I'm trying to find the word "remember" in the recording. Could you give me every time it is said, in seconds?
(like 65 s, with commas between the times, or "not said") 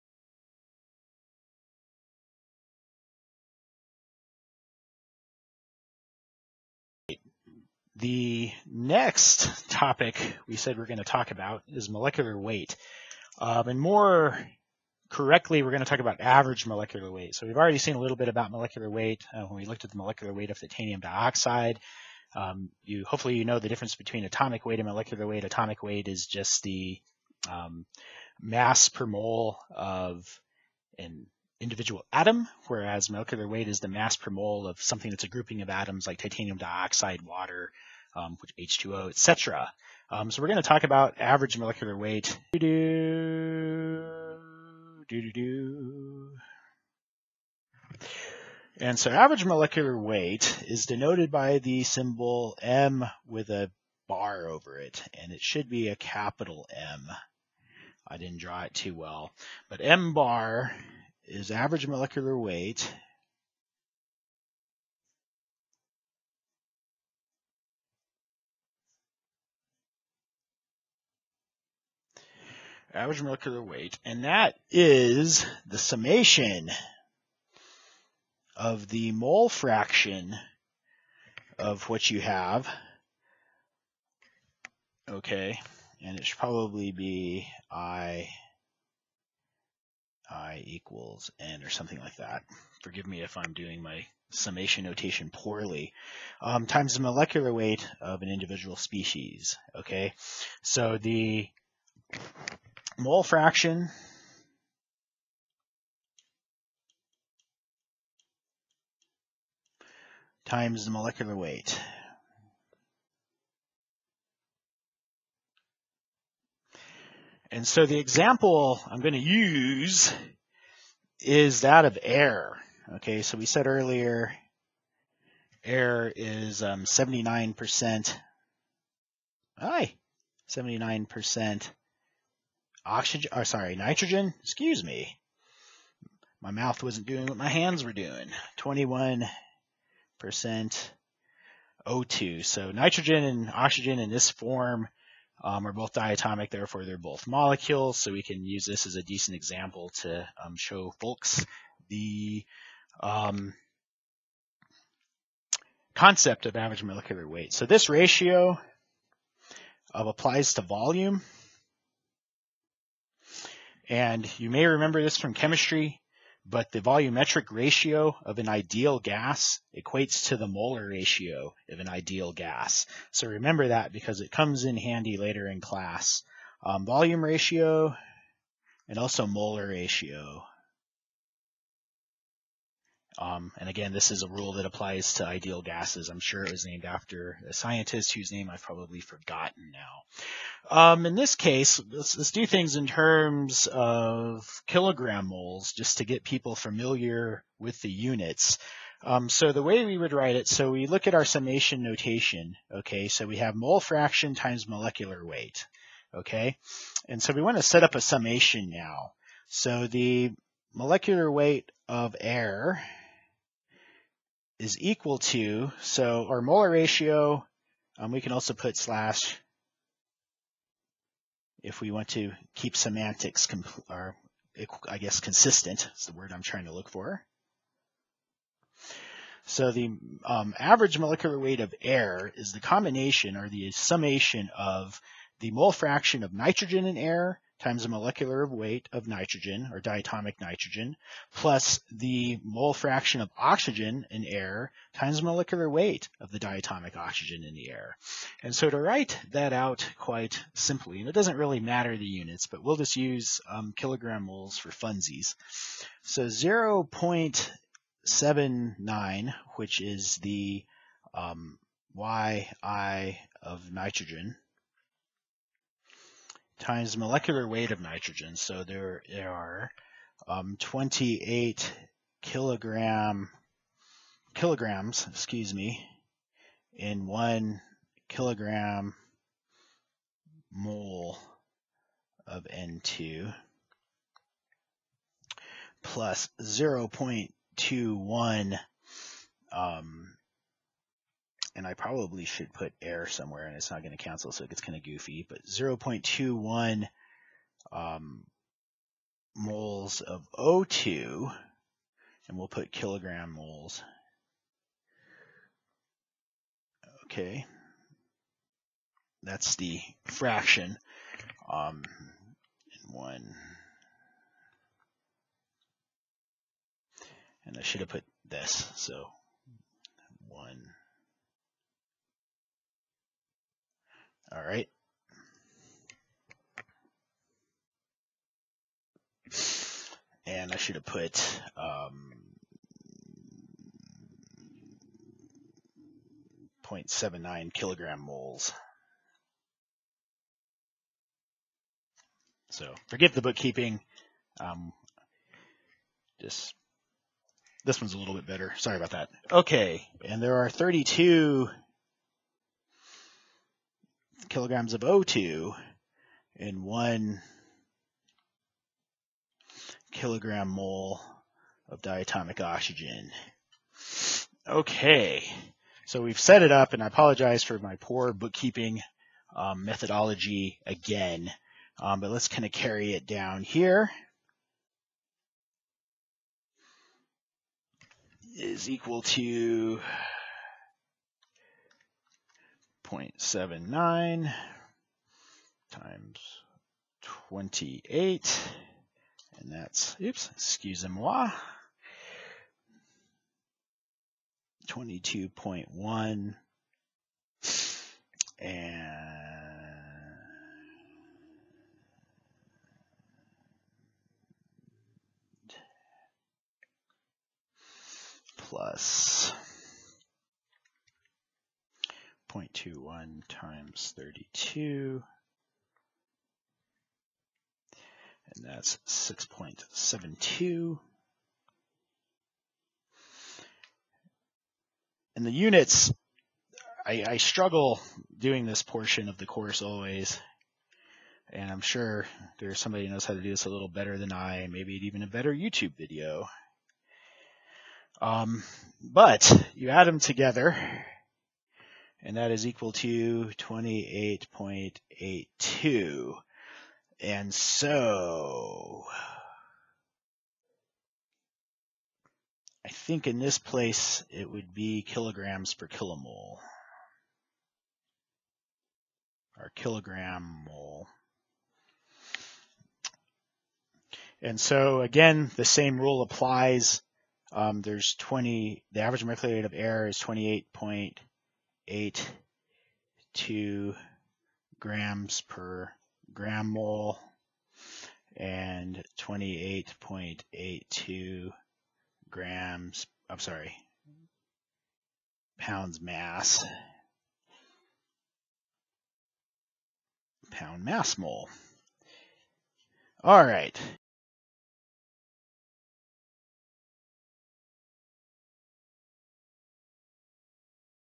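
164 s, 173 s.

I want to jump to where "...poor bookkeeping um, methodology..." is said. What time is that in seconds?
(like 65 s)
367 s.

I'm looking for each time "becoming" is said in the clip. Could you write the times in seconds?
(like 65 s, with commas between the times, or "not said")
not said.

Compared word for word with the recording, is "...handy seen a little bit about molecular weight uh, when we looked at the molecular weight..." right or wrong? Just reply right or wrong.
wrong.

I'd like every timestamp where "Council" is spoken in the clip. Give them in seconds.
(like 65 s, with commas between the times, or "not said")
not said.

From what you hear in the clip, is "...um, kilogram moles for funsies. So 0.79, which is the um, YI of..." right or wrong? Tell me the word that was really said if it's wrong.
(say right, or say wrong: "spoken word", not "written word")
right.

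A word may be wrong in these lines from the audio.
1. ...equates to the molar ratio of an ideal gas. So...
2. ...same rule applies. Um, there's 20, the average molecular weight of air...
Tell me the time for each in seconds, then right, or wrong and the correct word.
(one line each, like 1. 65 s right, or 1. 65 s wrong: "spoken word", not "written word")
1. 169 s right
2. 465 s right.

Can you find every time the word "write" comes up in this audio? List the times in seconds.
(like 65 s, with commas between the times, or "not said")
200 s, 248 s.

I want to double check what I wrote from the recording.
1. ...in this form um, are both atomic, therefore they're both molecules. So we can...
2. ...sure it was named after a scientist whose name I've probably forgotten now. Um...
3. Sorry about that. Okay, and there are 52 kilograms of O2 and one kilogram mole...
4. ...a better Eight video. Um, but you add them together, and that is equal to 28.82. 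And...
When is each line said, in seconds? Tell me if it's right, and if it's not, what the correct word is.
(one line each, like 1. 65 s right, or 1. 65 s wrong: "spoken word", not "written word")
1. 143 s wrong: "diatomic", not "atomic"
2. 186 s right
3. 348 s wrong: "32", not "52"
4. 435 s wrong: "YouTube", not "Eight".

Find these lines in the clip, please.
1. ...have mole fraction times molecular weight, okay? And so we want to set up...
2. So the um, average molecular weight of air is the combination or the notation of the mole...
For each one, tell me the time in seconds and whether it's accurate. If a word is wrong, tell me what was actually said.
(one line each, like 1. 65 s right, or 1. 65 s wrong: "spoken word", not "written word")
1. 203 s right
2. 229 s wrong: "summation", not "notation".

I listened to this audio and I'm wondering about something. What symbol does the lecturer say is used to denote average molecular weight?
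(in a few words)
M bar.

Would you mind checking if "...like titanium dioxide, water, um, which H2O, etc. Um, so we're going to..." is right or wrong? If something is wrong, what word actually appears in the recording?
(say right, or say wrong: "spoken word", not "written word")
right.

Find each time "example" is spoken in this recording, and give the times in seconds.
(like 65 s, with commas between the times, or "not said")
117 s, 149 s.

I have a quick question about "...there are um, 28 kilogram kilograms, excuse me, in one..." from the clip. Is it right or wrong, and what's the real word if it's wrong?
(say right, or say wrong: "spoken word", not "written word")
right.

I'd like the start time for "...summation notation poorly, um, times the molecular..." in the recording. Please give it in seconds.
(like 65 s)
94 s.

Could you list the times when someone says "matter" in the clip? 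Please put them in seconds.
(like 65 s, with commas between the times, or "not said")
251 s.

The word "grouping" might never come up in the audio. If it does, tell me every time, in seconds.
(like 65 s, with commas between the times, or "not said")
35 s.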